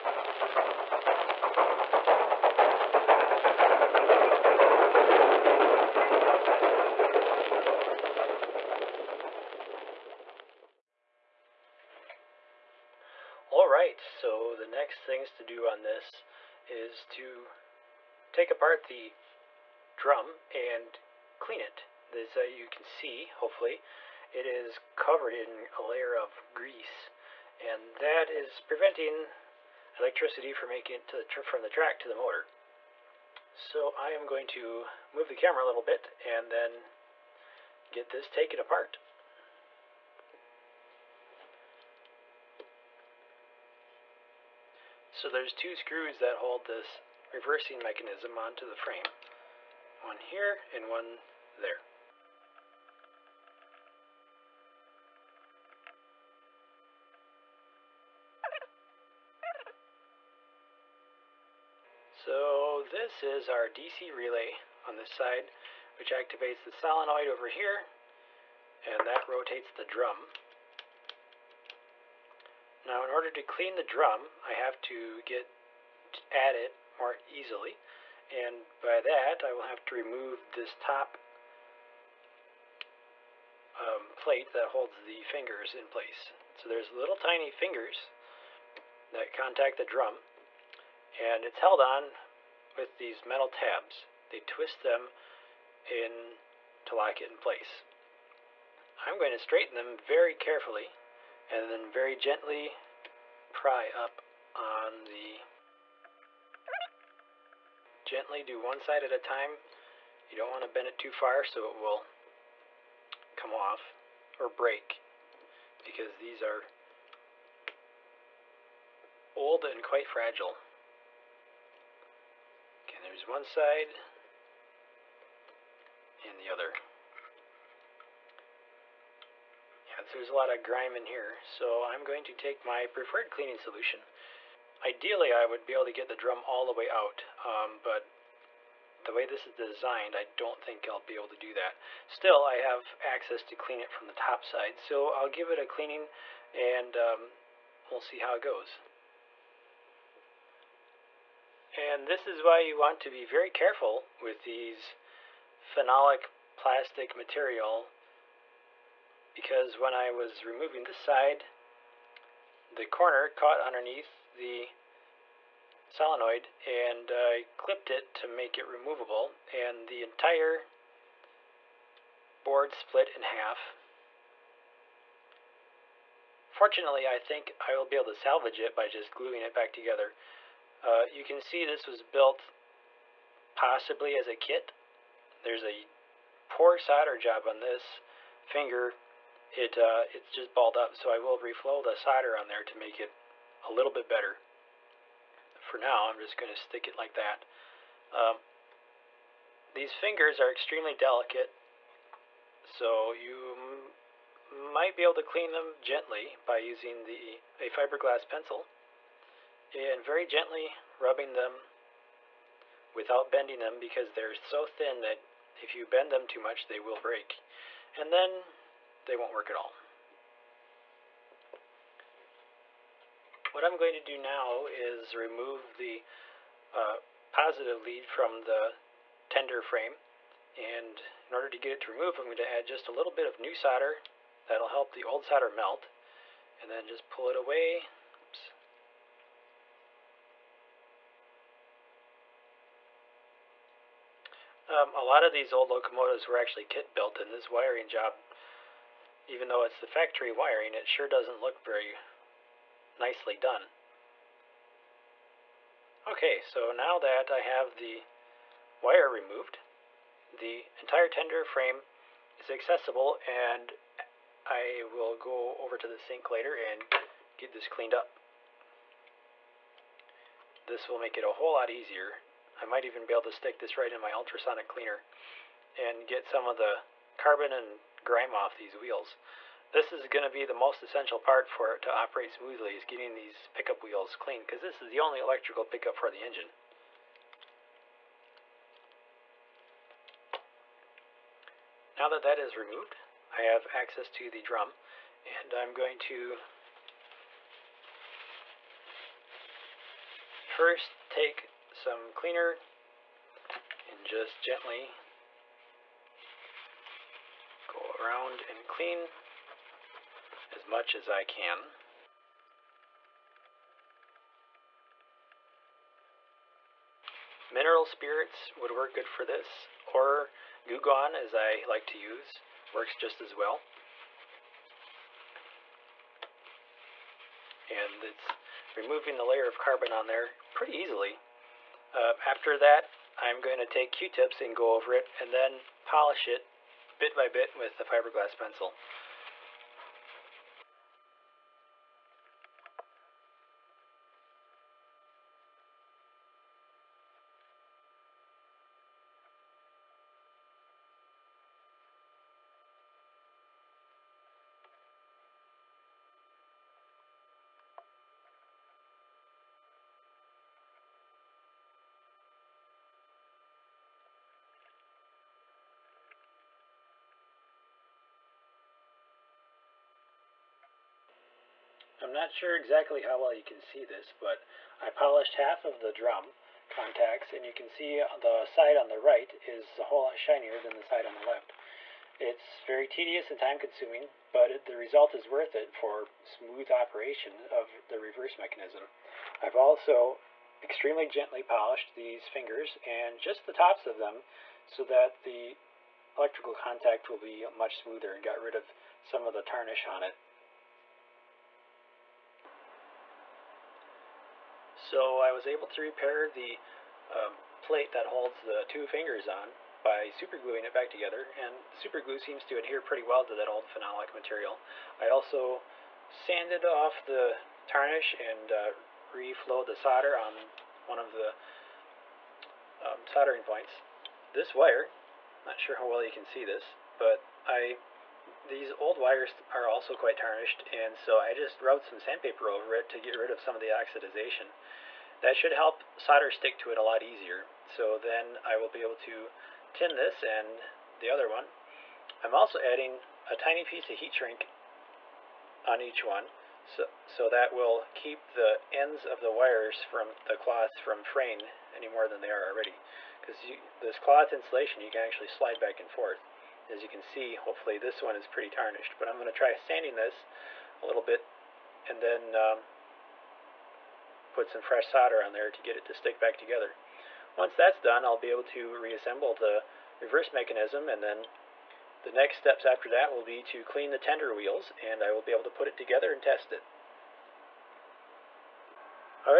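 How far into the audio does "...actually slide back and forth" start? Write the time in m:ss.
7:35.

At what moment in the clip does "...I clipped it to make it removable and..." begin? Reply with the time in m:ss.
2:47.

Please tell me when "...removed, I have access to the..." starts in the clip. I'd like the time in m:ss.
4:52.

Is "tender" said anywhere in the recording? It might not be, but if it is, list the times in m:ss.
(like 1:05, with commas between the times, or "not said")
3:49, 4:21, 7:53.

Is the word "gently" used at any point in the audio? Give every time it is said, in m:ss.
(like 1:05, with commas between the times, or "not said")
1:42, 1:48, 3:25, 3:30, 5:04, 6:31.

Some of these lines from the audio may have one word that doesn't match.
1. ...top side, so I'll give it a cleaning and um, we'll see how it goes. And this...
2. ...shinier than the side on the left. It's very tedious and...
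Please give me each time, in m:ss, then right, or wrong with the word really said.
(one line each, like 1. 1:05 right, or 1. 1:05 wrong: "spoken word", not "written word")
1. 2:24 right
2. 6:20 right.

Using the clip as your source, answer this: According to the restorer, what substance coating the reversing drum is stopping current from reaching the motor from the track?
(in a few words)
Grease.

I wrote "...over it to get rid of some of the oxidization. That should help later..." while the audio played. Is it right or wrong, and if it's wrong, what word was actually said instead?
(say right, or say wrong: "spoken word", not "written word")
wrong: "solder", not "later".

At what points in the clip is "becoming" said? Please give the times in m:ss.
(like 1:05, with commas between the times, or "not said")
not said.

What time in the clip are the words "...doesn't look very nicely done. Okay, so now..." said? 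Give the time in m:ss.
4:11.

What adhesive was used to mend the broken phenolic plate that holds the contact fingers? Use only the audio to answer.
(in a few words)
Superglue.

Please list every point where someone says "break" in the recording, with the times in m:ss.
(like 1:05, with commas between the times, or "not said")
1:54, 3:36.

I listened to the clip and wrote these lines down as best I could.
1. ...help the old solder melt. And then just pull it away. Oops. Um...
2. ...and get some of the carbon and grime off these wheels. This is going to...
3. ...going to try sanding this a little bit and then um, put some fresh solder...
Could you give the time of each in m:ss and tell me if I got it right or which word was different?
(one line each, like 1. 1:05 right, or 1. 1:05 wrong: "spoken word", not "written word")
1. 3:54 right
2. 4:35 right
3. 7:39 right.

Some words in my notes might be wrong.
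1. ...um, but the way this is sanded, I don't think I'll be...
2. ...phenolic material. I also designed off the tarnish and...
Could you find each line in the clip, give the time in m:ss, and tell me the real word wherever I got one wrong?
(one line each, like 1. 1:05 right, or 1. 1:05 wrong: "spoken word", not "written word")
1. 2:17 wrong: "designed", not "sanded"
2. 6:53 wrong: "sanded", not "designed".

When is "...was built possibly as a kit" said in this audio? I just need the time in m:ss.
3:01.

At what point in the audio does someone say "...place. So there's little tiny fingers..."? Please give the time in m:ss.
1:25.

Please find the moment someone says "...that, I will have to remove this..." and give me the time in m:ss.
1:19.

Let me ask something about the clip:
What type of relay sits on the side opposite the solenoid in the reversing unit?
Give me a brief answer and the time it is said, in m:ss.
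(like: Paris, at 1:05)
DC relay, at 1:03.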